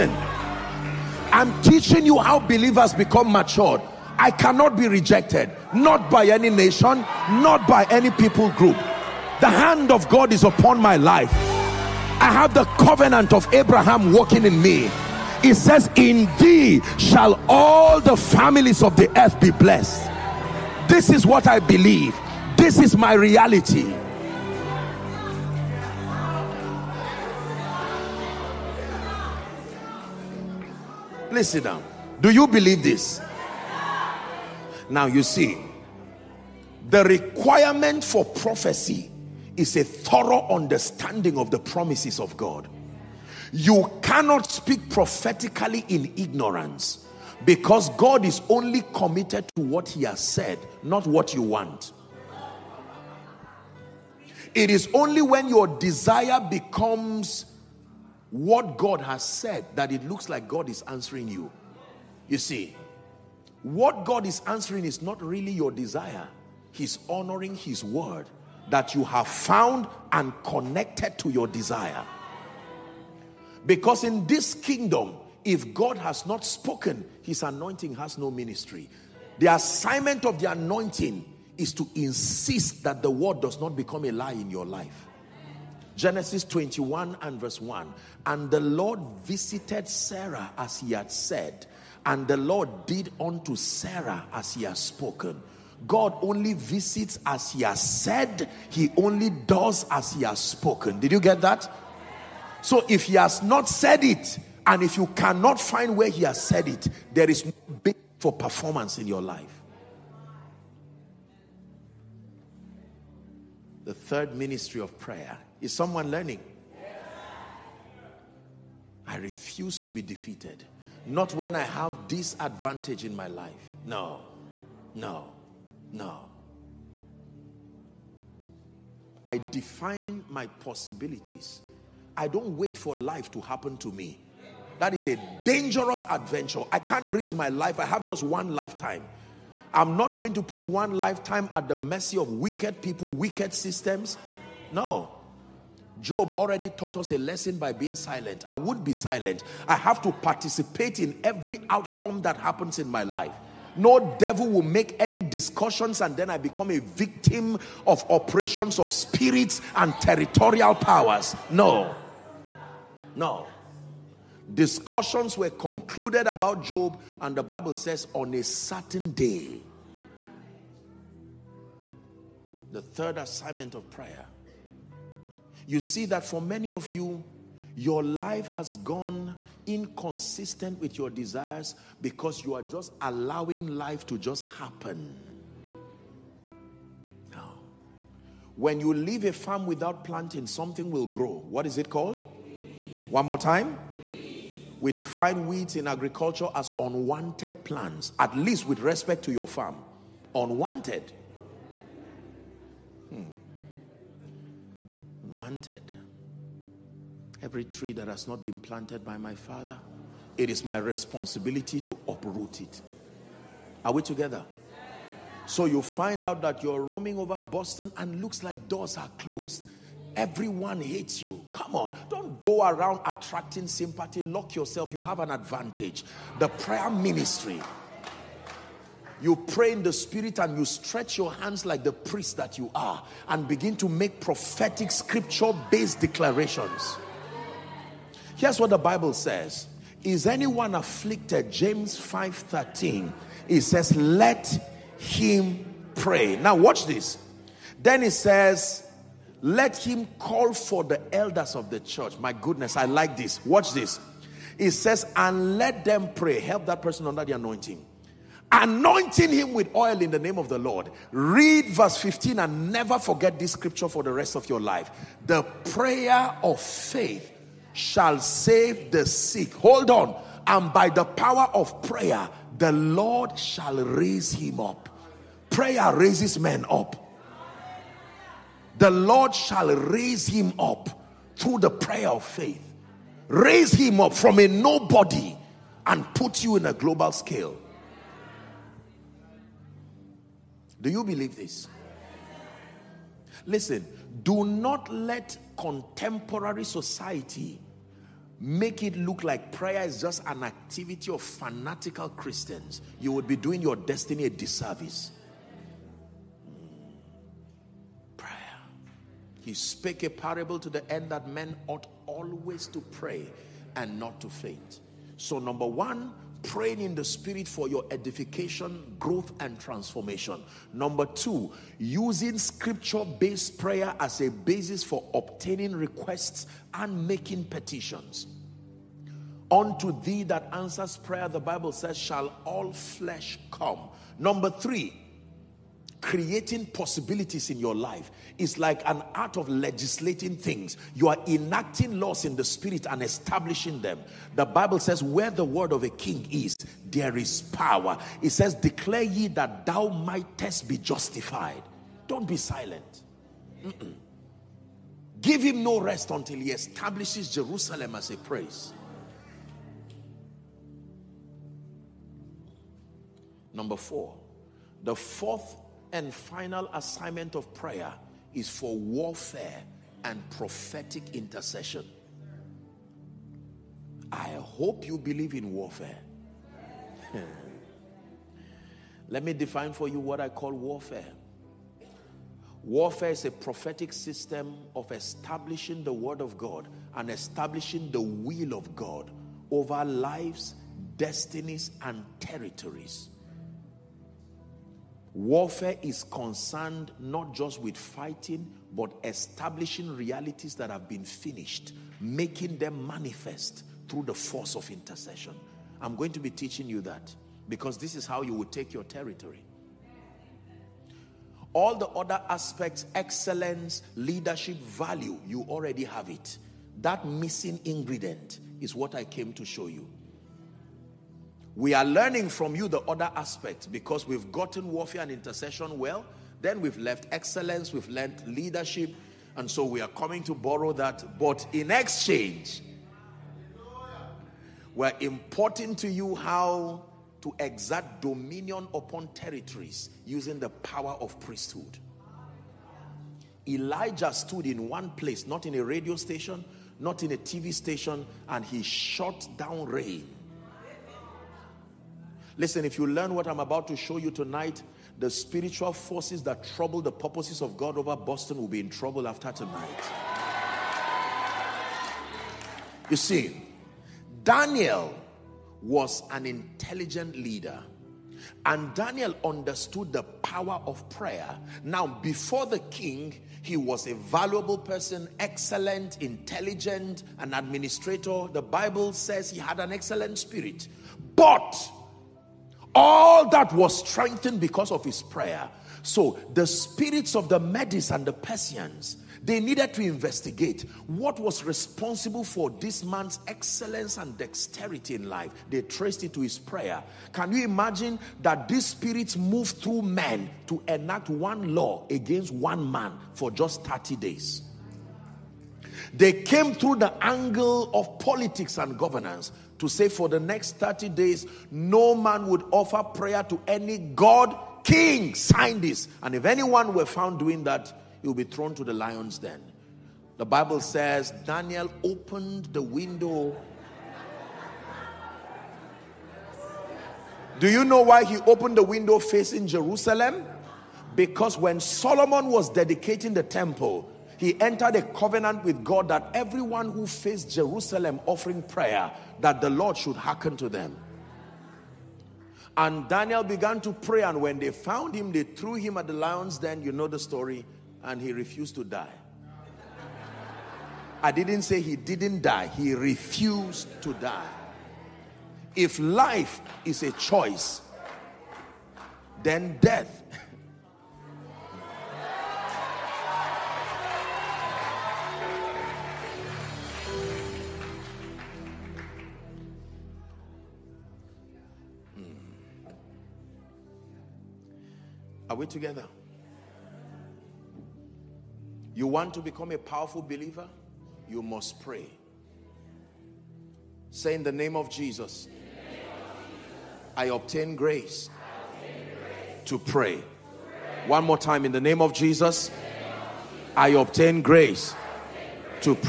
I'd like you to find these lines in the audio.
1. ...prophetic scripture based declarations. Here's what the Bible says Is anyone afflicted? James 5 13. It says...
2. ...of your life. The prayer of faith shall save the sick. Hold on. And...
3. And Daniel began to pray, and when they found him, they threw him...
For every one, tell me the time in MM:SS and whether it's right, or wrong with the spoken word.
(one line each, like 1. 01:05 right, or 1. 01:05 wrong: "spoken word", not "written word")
1. 03:54 right
2. 04:24 right
3. 09:02 right.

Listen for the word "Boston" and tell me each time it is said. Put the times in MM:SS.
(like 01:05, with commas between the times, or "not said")
03:37, 07:37.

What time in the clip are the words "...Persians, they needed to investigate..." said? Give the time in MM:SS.
08:08.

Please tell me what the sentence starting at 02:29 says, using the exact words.
I have to participate in every outcome that happens in my life.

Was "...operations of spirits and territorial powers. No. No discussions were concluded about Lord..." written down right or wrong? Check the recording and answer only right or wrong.
wrong.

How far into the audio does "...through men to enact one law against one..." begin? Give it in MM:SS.
08:19.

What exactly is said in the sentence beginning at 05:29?
Unto thee that answers prayer, the Bible says, shall all flesh come.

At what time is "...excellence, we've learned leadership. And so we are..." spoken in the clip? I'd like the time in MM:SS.
07:07.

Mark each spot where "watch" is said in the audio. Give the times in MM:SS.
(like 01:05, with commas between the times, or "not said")
04:06, 04:13.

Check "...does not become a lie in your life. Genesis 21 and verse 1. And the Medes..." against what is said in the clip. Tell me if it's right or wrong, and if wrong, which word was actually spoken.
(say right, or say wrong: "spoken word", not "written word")
wrong: "Lord", not "Medes".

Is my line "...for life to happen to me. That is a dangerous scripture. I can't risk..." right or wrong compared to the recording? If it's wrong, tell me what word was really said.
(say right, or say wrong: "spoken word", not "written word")
wrong: "adventure", not "scripture".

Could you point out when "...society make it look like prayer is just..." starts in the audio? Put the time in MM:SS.
04:56.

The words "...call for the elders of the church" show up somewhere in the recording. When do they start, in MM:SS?
04:10.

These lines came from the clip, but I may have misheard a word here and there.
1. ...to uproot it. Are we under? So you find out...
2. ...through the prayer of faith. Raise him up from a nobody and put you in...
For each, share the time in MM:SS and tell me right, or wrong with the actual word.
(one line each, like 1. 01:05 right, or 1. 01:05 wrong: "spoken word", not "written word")
1. 03:31 wrong: "together", not "under"
2. 04:41 right.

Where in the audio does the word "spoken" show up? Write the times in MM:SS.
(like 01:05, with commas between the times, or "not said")
01:16, 01:34, 01:40.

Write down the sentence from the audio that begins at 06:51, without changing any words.
All the other aspects, excellence, leadership, value, you already have it.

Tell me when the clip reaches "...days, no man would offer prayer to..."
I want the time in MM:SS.
08:30.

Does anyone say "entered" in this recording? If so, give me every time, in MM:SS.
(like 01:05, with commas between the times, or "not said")
08:54.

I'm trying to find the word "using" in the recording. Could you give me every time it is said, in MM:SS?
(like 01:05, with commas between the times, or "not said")
05:21, 07:20.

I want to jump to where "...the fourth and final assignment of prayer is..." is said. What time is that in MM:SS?
06:04.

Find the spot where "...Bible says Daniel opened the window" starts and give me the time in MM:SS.
08:40.